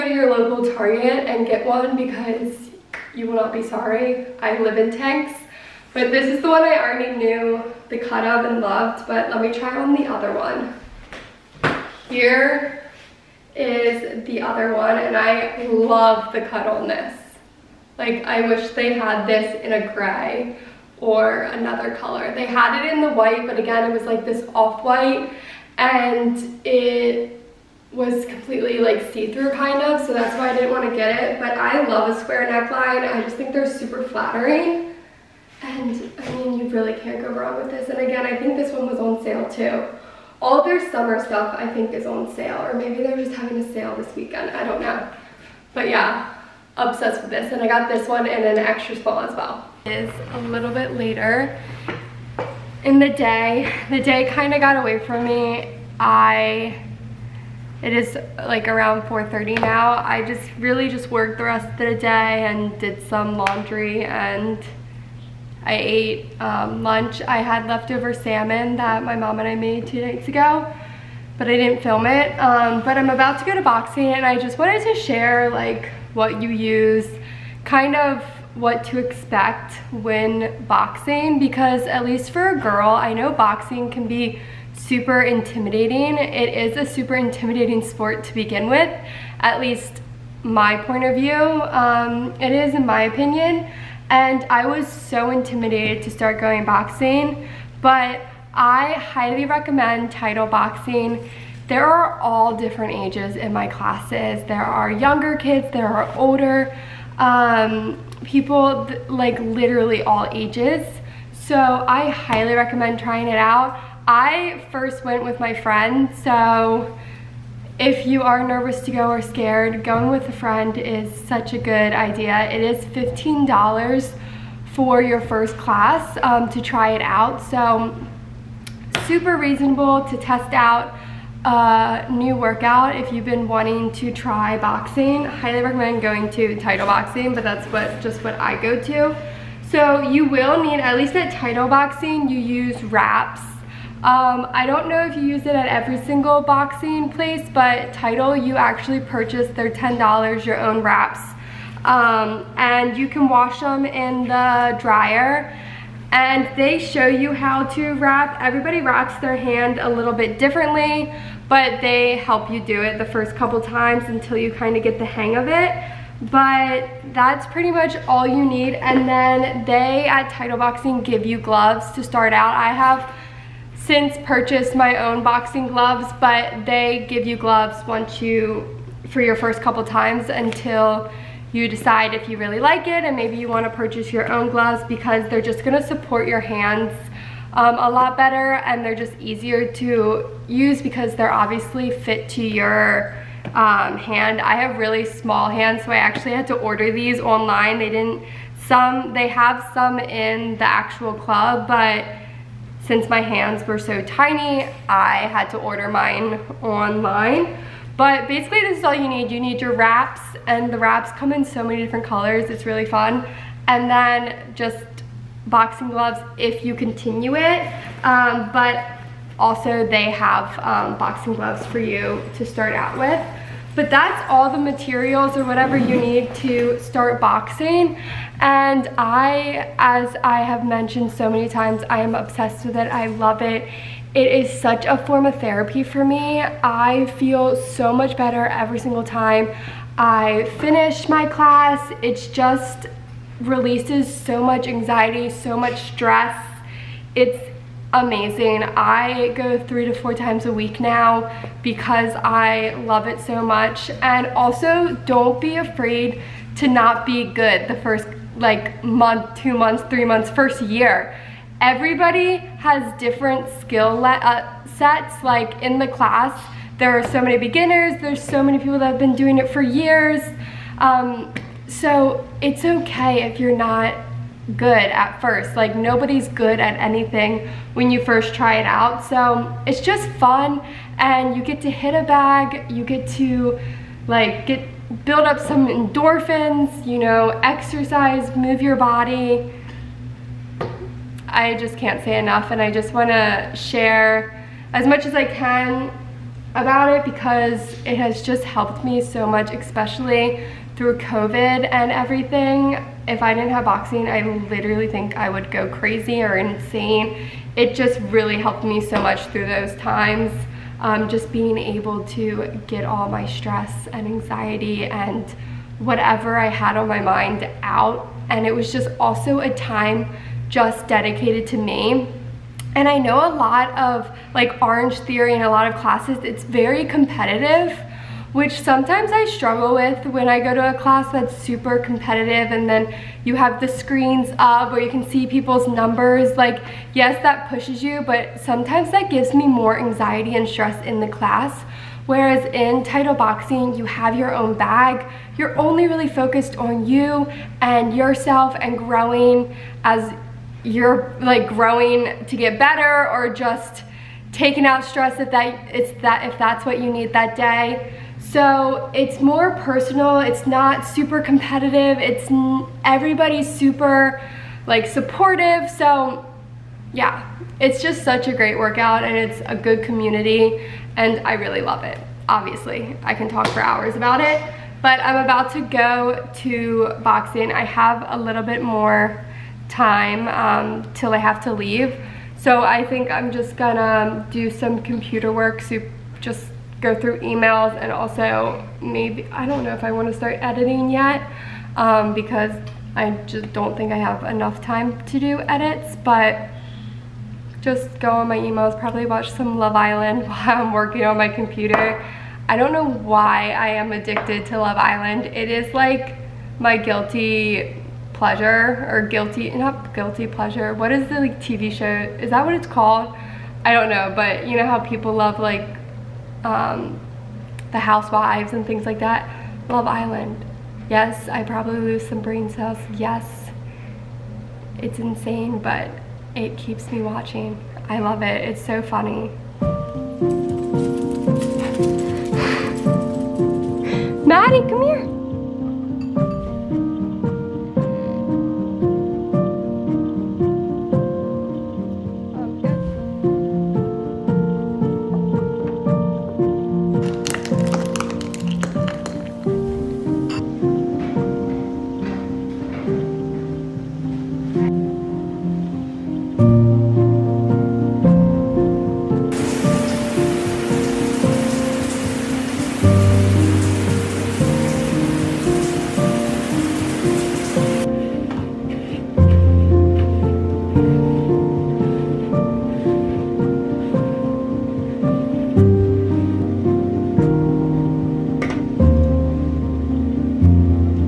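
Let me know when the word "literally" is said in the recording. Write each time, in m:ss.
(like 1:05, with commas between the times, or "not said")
1:49, 5:04.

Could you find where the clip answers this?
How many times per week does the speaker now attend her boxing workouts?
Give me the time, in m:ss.
4:09.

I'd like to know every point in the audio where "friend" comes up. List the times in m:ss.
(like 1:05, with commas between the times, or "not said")
1:55, 2:00.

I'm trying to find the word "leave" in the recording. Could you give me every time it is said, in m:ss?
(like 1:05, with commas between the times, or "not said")
6:21.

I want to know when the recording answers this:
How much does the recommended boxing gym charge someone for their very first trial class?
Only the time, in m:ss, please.
2:02.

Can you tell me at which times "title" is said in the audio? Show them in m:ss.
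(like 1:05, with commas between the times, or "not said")
1:40, 2:16, 2:21, 2:27, 2:50, 5:42.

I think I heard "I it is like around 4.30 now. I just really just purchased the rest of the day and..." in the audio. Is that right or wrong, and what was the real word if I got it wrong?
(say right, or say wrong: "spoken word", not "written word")
wrong: "worked", not "purchased".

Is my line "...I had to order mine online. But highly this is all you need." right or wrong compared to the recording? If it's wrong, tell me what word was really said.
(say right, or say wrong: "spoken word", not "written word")
wrong: "basically", not "highly".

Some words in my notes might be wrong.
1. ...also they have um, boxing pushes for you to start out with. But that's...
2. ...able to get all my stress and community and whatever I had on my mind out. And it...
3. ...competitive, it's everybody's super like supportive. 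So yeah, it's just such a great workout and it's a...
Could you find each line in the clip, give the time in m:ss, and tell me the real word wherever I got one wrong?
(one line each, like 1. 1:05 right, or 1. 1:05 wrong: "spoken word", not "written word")
1. 3:39 wrong: "gloves", not "pushes"
2. 5:11 wrong: "anxiety", not "community"
3. 6:01 right.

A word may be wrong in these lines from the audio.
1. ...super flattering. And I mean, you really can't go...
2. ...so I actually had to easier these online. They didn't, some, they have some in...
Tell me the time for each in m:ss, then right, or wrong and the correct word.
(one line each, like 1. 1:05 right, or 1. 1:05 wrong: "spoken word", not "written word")
1. 0:33 right
2. 3:15 wrong: "order", not "easier".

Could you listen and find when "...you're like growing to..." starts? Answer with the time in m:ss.
5:50.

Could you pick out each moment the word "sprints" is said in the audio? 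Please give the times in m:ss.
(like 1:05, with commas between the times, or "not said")
not said.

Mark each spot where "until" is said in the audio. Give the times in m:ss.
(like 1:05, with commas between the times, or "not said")
2:44, 3:00.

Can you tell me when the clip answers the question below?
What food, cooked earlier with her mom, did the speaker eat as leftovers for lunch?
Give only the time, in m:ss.
1:08.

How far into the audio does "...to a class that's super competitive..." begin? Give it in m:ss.
5:30.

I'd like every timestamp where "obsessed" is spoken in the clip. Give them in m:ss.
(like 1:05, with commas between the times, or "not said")
0:46, 3:52.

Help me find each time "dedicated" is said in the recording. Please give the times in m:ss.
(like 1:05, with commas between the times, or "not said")
5:20.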